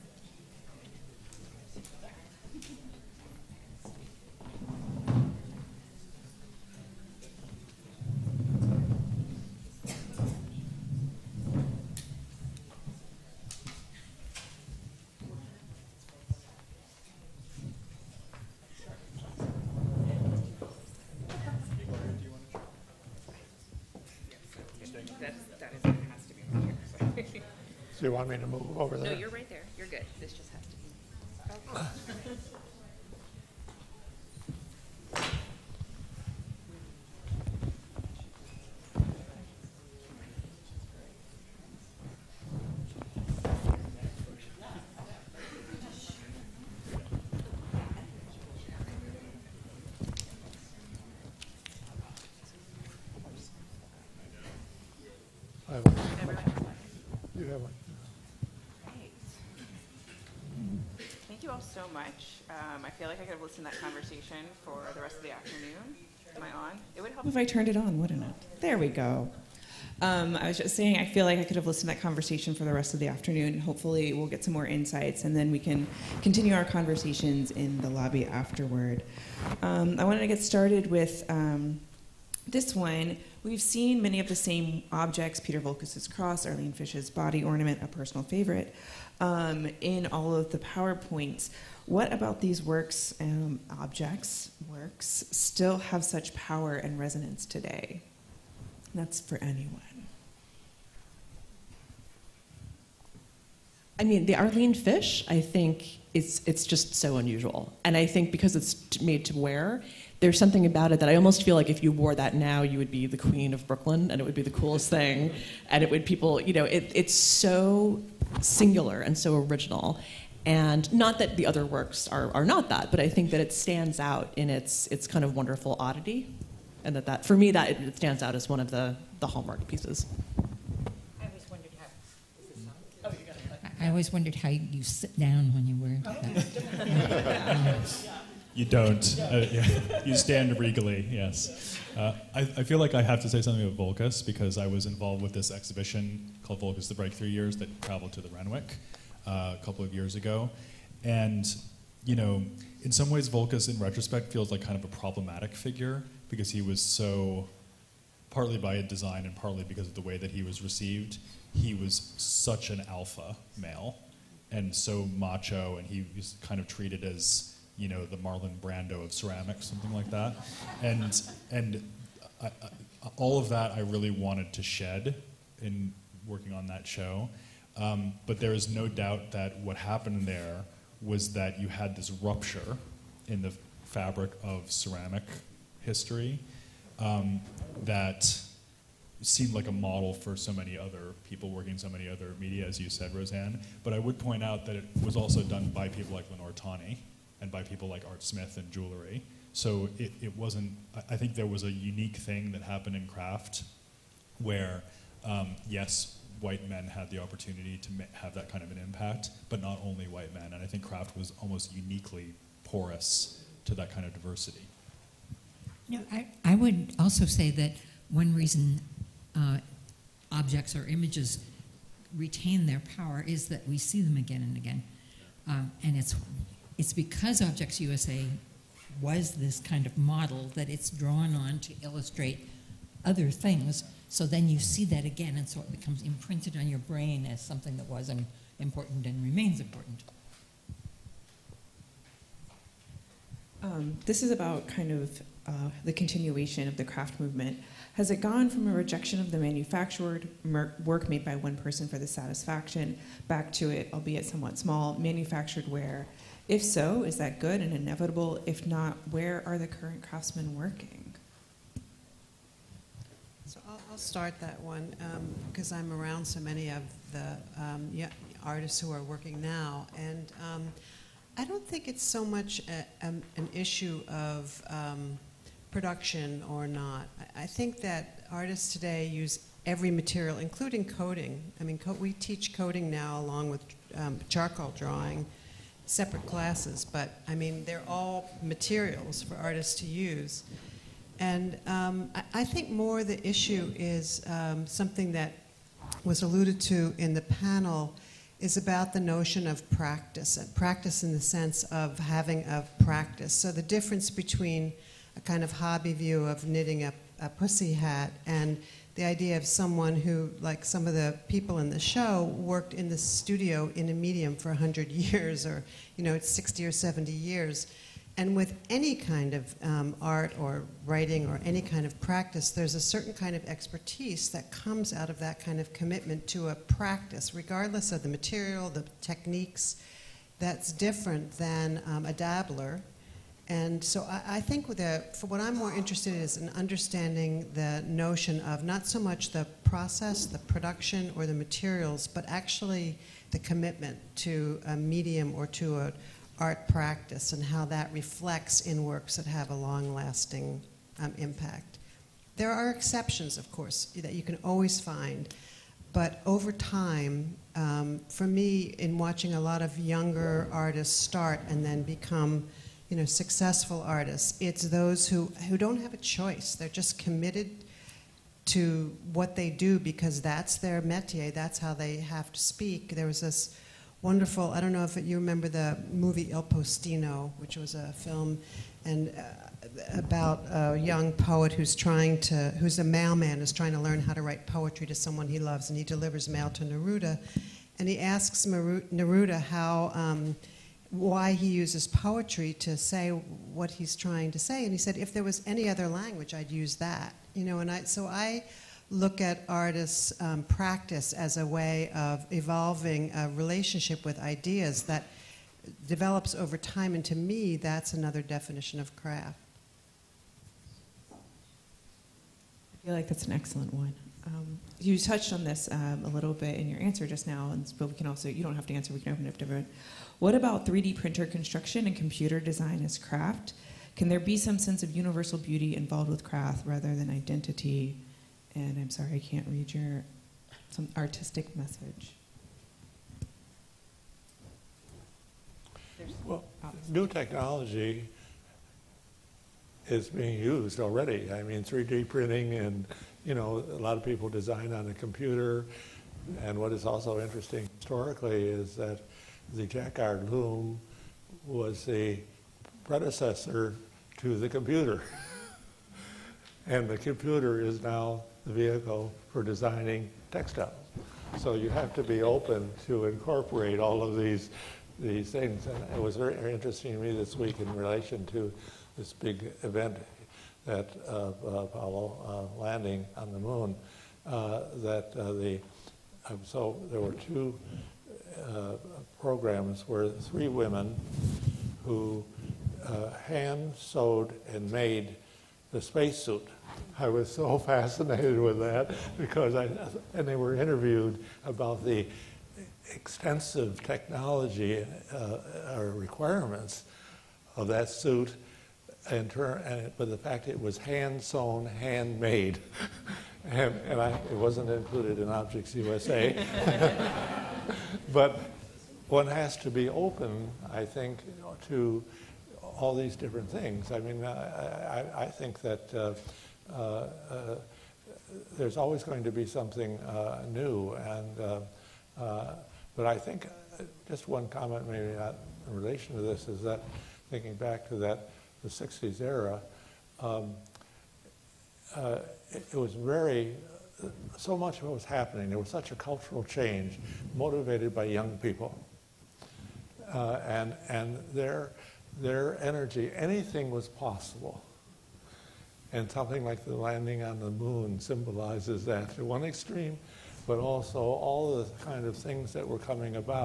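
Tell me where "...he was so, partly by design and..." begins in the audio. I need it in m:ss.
2:36.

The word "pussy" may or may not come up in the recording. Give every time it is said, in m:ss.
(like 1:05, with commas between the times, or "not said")
5:07.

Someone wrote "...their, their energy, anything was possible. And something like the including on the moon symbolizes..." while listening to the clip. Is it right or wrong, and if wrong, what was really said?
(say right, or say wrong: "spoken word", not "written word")
wrong: "landing", not "including".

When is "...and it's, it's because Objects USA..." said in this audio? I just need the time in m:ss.
3:45.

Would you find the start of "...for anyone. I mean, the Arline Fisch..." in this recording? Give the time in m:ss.
1:39.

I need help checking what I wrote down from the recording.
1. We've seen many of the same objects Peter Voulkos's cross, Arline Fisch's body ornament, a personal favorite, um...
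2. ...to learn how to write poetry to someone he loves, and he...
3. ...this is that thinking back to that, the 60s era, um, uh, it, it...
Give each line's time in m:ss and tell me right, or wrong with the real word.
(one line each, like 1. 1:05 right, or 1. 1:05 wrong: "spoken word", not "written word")
1. 1:23 right
2. 6:23 right
3. 8:46 right.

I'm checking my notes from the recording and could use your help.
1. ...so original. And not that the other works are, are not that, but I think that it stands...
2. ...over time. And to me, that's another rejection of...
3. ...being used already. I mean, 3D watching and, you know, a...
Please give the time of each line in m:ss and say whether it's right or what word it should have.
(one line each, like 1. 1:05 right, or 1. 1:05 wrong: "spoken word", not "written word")
1. 1:59 right
2. 6:46 wrong: "definition", not "rejection"
3. 7:20 wrong: "printing", not "watching".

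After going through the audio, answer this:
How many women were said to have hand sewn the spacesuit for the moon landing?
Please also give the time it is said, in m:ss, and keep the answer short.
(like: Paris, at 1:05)
3, at 8:00.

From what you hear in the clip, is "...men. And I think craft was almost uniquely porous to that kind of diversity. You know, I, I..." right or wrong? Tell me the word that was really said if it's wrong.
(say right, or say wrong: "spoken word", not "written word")
right.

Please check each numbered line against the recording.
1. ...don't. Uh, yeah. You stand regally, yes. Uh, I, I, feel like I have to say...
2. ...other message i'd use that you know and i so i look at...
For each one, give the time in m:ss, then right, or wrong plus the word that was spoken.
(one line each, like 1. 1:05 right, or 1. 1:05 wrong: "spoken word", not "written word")
1. 2:18 right
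2. 6:35 wrong: "language", not "message".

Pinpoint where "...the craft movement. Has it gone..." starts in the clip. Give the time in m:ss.
4:06.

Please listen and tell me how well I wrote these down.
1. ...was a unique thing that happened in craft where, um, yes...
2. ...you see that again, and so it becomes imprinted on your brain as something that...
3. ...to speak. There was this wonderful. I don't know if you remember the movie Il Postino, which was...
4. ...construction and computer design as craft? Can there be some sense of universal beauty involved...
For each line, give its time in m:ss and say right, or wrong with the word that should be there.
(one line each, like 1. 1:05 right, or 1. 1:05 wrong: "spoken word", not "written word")
1. 3:21 right
2. 3:54 right
3. 6:12 right
4. 7:01 right.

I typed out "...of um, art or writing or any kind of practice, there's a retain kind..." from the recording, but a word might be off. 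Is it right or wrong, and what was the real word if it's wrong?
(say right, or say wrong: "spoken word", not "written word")
wrong: "certain", not "retain".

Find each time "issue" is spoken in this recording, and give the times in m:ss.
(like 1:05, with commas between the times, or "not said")
4:33, 4:53.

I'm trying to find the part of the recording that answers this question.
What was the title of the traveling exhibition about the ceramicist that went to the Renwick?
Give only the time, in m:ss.
2:26.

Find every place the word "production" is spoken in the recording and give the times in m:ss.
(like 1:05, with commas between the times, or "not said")
4:35, 5:40.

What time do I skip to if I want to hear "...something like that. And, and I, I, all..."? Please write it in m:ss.
2:49.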